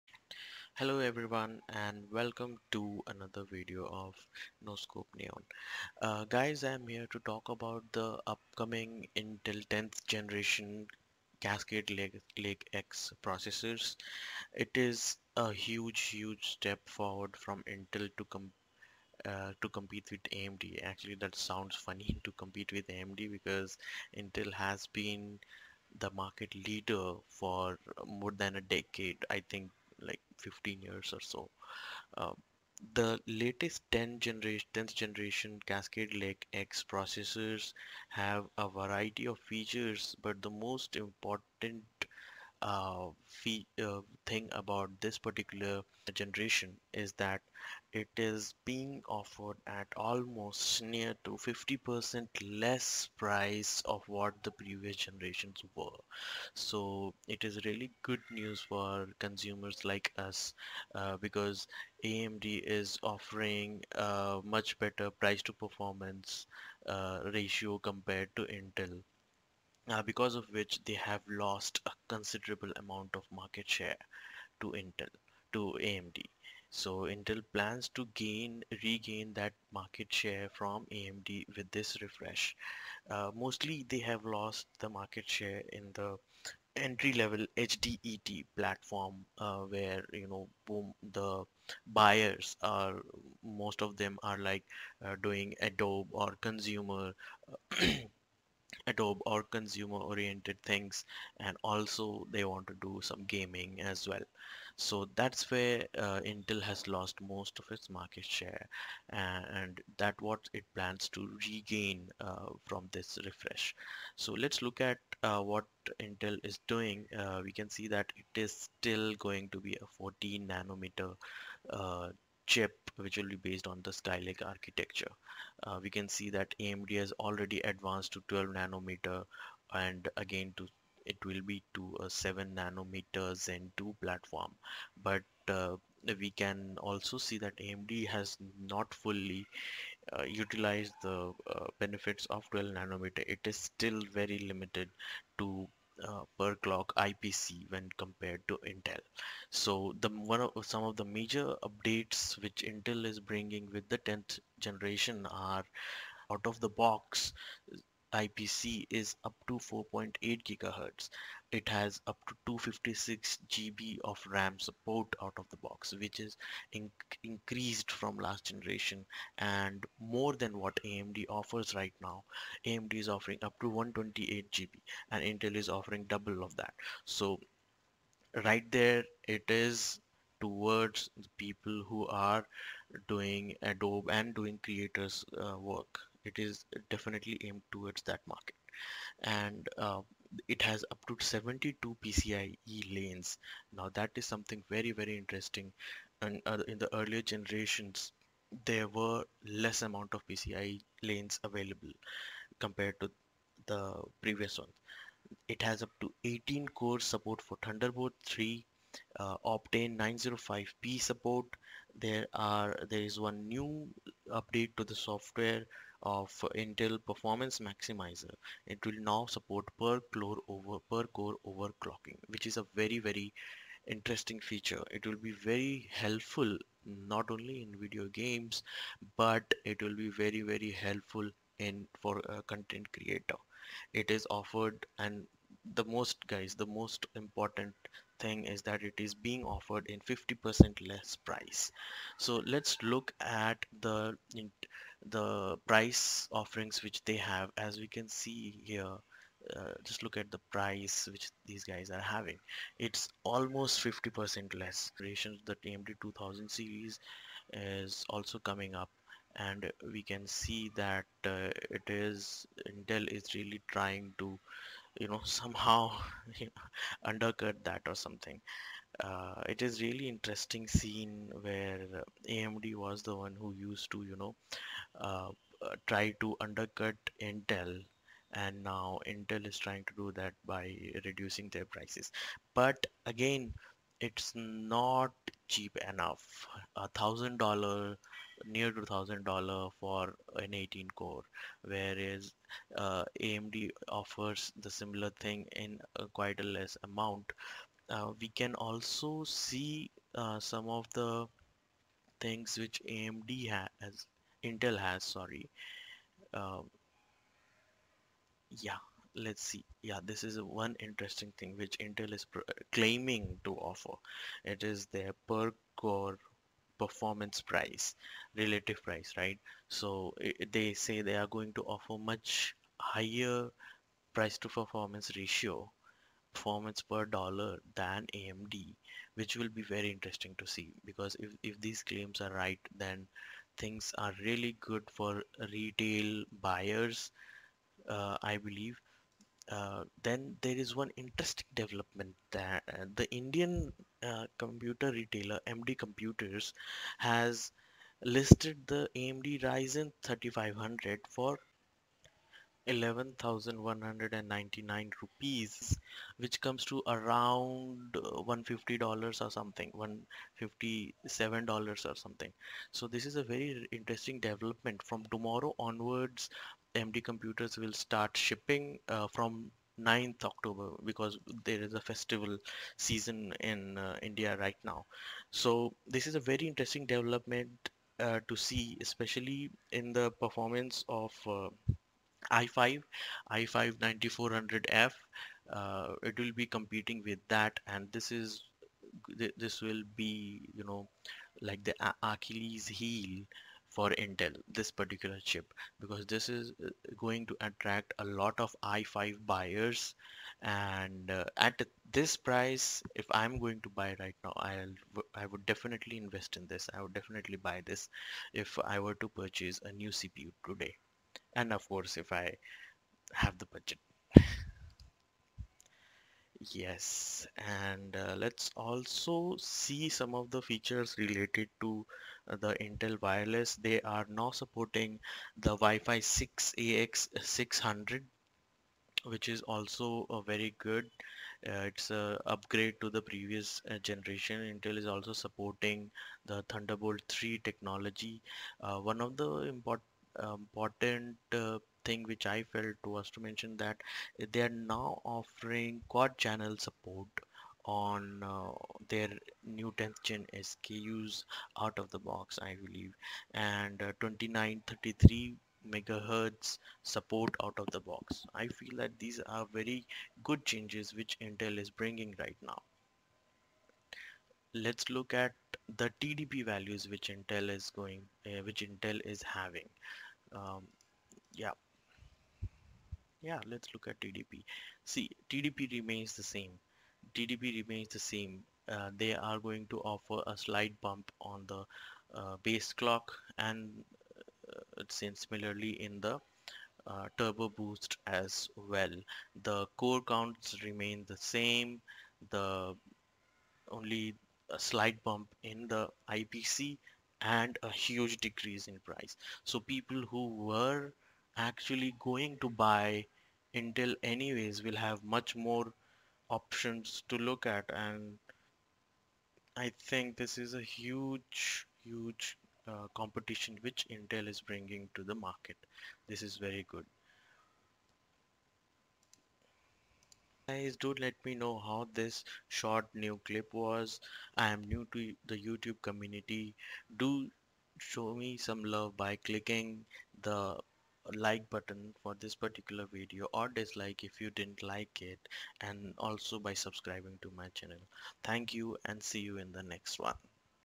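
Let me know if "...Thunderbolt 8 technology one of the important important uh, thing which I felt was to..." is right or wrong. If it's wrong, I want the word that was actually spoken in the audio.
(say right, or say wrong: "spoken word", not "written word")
wrong: "3", not "8".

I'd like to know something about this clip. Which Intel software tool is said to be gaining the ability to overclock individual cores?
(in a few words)
Intel Performance Maximizer.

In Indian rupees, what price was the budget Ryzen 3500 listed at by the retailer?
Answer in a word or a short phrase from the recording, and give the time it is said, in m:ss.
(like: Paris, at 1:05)
11,199 rupees, at 5:52.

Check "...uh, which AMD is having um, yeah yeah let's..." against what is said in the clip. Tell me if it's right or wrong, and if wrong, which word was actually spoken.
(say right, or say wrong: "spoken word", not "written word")
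wrong: "Intel", not "AMD".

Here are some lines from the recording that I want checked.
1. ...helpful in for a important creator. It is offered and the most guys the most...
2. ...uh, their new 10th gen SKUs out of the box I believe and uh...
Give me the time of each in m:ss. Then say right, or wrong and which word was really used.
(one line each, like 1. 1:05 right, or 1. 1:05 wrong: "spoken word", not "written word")
1. 3:50 wrong: "content", not "important"
2. 7:28 right.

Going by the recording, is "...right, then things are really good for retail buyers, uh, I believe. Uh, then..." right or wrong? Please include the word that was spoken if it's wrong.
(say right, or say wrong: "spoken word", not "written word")
right.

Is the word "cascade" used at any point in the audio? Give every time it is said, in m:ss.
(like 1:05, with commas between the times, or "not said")
0:11, 0:35.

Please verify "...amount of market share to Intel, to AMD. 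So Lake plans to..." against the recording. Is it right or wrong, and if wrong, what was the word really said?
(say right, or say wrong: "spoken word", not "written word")
wrong: "Intel", not "Lake".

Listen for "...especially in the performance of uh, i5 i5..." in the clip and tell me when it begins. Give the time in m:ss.
6:18.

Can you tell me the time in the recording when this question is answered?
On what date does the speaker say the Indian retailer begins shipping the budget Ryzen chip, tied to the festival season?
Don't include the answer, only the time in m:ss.
6:09.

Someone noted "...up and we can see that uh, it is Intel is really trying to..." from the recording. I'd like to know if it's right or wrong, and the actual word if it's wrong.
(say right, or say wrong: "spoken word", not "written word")
right.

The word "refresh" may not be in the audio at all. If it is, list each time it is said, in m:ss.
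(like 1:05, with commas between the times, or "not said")
1:22, 1:53.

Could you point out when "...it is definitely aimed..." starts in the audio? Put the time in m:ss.
3:06.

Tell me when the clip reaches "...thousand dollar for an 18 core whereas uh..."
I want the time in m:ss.
4:48.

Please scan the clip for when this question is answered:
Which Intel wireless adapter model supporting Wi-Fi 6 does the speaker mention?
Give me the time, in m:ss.
7:06.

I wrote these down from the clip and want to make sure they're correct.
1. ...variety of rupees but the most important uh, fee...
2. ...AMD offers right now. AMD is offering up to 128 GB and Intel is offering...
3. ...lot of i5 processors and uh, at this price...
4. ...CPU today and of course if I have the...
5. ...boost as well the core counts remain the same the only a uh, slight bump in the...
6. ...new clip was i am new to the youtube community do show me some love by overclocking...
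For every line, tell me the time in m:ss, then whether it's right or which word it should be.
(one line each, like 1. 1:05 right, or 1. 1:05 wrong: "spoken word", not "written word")
1. 0:38 wrong: "features", not "rupees"
2. 2:50 right
3. 6:38 wrong: "buyers", not "processors"
4. 6:49 right
5. 8:07 right
6. 8:43 wrong: "clicking", not "overclocking".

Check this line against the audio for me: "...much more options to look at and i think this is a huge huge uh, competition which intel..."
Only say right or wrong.
right.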